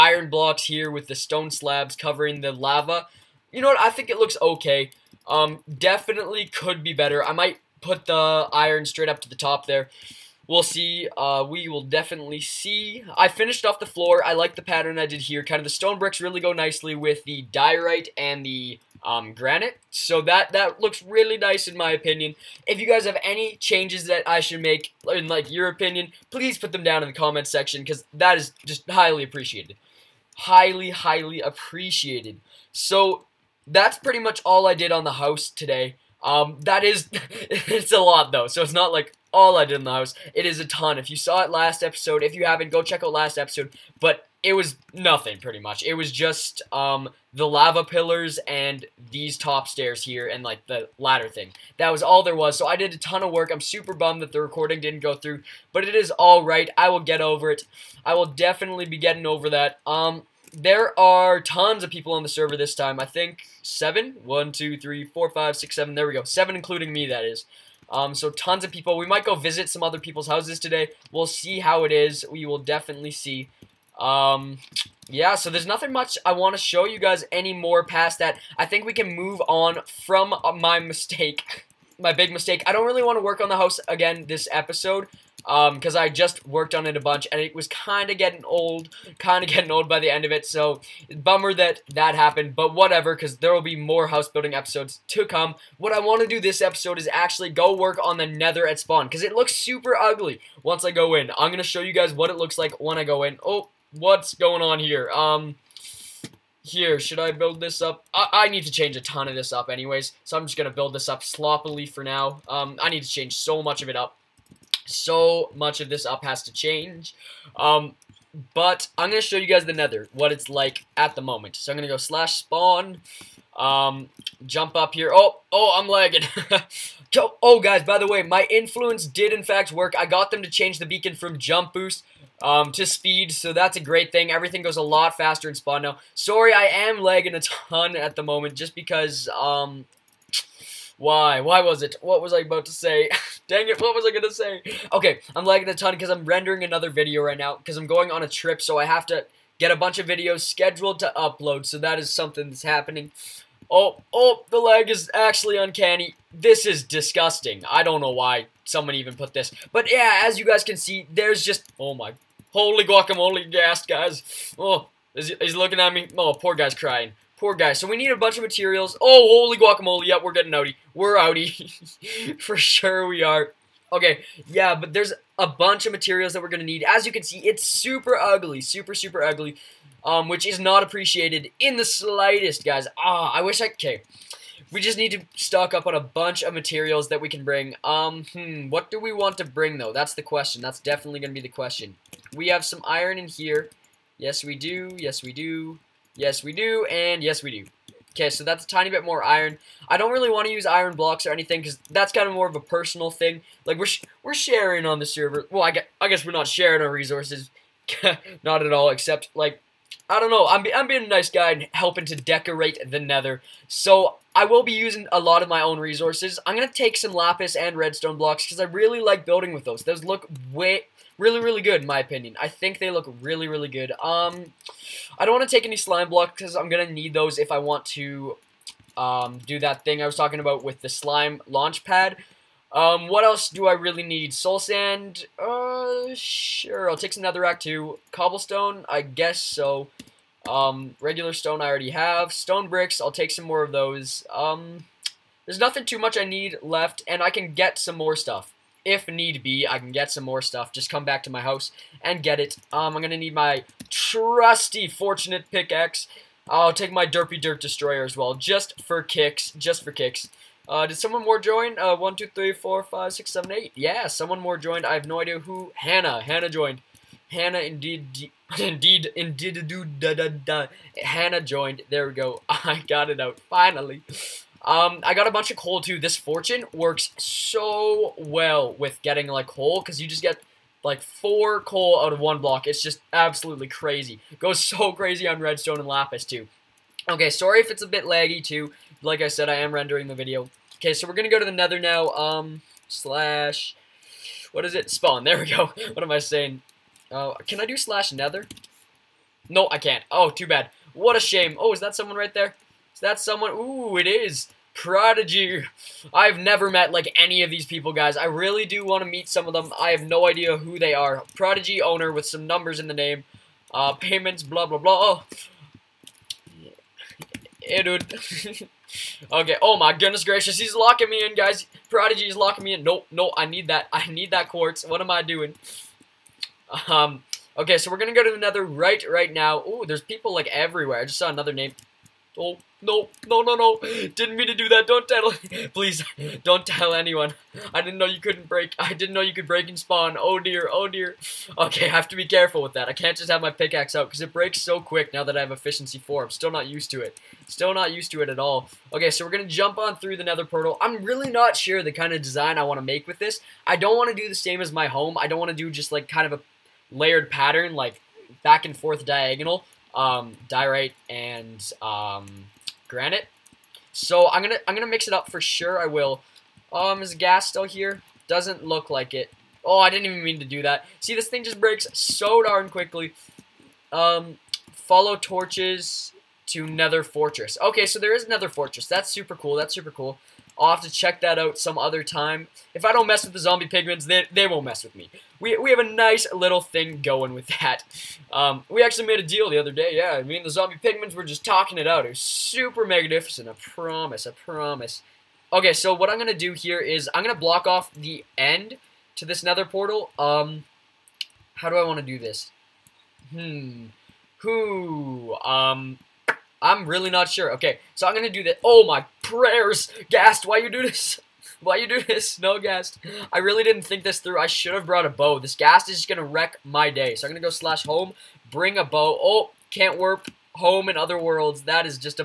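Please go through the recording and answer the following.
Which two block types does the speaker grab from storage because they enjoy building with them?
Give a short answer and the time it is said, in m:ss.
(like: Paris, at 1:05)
Lapis and redstone blocks, at 3:37.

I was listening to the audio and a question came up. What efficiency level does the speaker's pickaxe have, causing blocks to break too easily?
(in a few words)
4.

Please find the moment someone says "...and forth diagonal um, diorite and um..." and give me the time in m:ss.
5:58.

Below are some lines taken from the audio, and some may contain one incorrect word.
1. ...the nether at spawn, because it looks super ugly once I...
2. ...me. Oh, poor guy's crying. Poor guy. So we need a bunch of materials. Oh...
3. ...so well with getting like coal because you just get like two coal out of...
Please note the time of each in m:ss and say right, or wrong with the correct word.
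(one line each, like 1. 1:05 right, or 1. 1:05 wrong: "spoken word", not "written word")
1. 1:38 right
2. 2:45 right
3. 4:37 wrong: "four", not "two".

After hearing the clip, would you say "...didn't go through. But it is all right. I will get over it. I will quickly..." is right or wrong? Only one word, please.
wrong.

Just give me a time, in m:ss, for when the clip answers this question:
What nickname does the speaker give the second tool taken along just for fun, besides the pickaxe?
4:17.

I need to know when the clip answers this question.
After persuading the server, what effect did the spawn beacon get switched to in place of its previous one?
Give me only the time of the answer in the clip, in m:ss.
2:12.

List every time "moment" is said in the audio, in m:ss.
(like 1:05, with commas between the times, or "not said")
2:01, 2:18.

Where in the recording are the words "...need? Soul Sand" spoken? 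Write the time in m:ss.
3:54.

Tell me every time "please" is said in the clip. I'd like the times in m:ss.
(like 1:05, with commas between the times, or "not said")
0:26, 5:35.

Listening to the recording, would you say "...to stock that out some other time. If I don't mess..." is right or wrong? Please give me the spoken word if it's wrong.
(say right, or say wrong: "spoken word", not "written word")
wrong: "check", not "stock".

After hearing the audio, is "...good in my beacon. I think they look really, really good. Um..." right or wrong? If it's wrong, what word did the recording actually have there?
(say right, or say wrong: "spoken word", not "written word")
wrong: "opinion", not "beacon".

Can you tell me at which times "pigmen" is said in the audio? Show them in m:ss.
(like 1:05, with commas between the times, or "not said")
6:23, 6:30.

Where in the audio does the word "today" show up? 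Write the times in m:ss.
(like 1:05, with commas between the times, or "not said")
0:35, 1:10.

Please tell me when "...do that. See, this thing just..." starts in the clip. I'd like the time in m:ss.
6:10.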